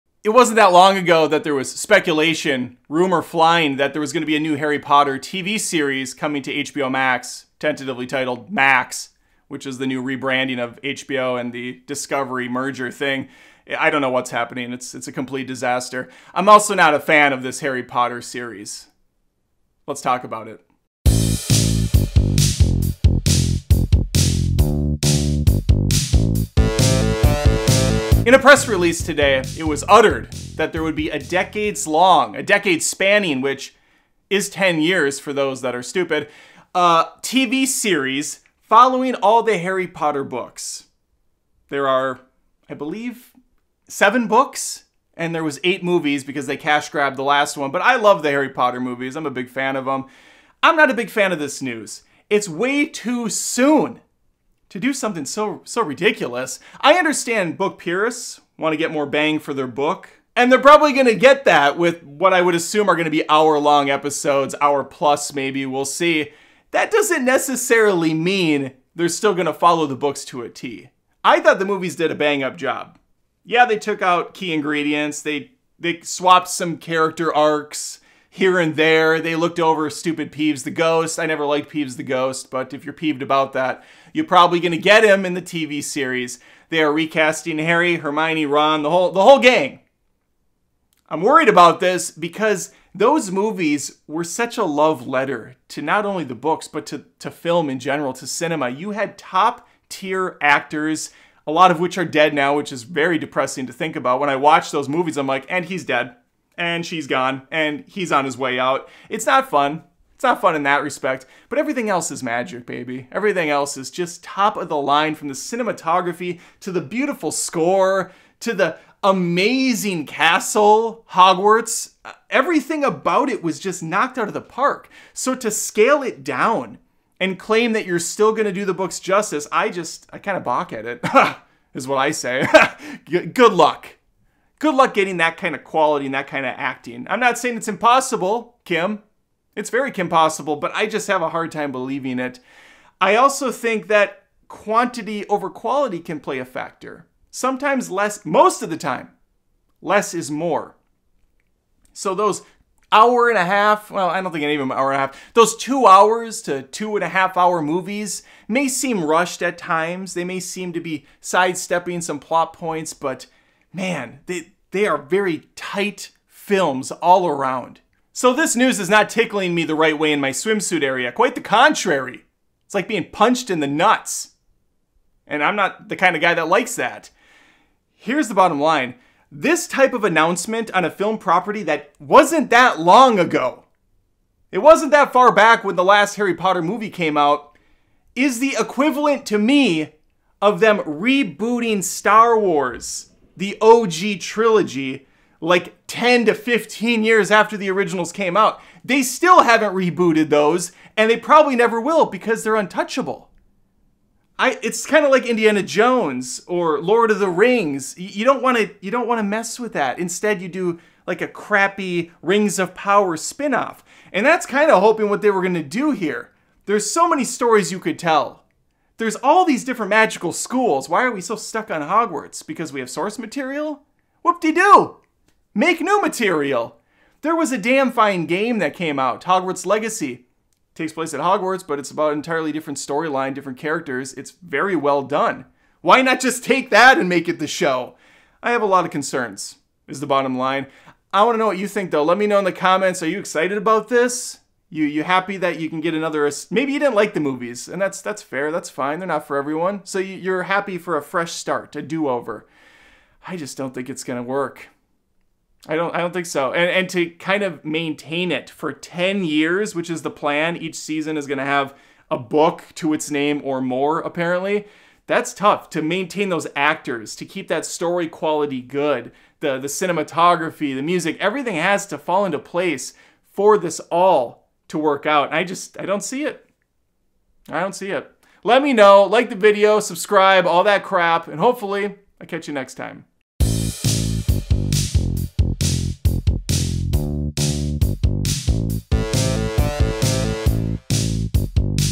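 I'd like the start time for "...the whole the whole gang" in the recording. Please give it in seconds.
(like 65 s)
88 s.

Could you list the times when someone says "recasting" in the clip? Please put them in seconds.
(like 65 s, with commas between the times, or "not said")
86 s.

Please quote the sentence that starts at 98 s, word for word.
You had top tier actors, a lot of which are dead now, which is very depressing to think about.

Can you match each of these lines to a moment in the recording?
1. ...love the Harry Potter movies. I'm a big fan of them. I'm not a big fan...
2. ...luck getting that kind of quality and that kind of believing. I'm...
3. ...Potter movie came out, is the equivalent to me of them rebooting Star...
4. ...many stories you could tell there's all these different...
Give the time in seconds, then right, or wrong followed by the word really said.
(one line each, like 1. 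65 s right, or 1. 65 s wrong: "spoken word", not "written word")
1. 47 s right
2. 134 s wrong: "acting", not "believing"
3. 186 s right
4. 217 s right.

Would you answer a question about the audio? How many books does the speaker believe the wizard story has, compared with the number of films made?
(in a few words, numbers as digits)
7.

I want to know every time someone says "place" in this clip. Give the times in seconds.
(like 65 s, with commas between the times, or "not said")
230 s, 272 s.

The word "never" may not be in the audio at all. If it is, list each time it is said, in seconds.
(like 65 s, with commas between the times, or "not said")
81 s, 201 s.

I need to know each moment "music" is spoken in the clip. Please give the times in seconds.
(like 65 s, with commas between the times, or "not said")
270 s.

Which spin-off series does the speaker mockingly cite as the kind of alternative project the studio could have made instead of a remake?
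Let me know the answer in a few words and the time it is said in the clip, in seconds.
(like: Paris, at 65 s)
Rings of Power, at 212 s.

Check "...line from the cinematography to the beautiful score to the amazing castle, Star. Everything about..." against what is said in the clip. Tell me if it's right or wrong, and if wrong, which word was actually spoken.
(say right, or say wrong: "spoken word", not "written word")
wrong: "Hogwarts", not "Star".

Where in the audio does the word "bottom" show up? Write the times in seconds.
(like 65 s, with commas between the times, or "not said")
178 s, 240 s.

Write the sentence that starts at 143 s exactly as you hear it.
I also think that quantity over quality can play a factor.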